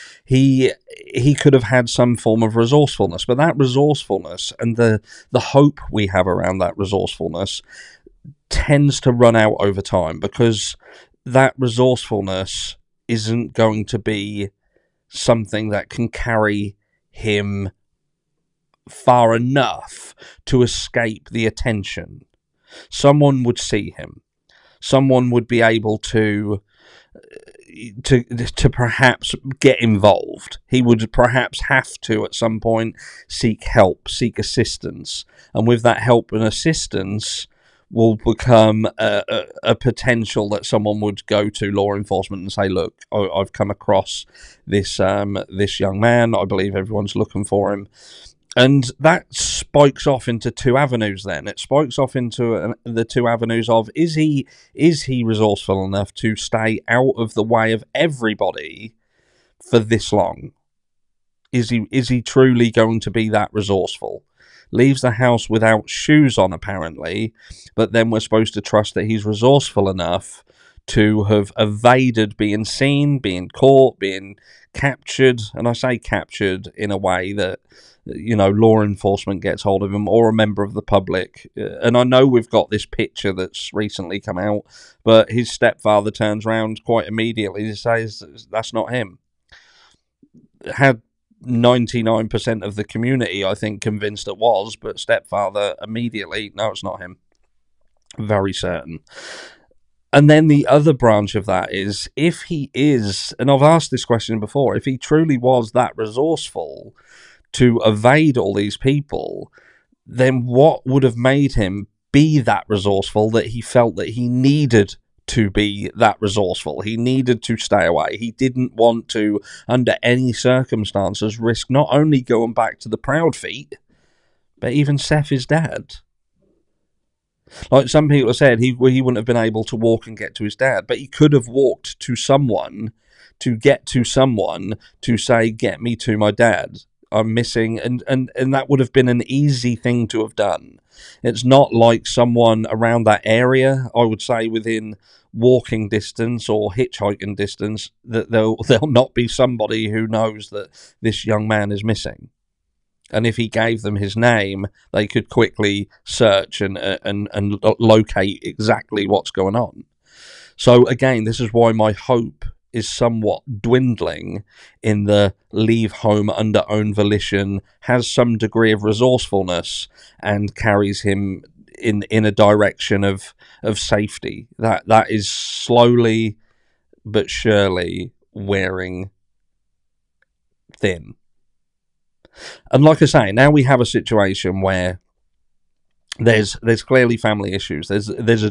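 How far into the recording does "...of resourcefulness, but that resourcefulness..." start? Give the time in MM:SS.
00:02.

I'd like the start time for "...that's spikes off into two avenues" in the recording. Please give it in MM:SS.
00:48.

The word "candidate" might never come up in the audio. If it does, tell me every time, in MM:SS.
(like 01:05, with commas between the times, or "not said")
not said.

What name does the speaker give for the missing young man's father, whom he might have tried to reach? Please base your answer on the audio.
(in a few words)
Seth.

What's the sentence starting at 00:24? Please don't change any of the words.
Someone would be able to to to perhaps get involved.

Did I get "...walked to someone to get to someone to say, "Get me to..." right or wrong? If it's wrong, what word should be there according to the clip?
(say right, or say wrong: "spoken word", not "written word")
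right.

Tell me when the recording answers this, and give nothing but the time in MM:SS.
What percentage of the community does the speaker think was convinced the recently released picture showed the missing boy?
01:31.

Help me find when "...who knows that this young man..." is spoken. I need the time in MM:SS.
02:29.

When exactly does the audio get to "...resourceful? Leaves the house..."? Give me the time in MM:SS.
01:03.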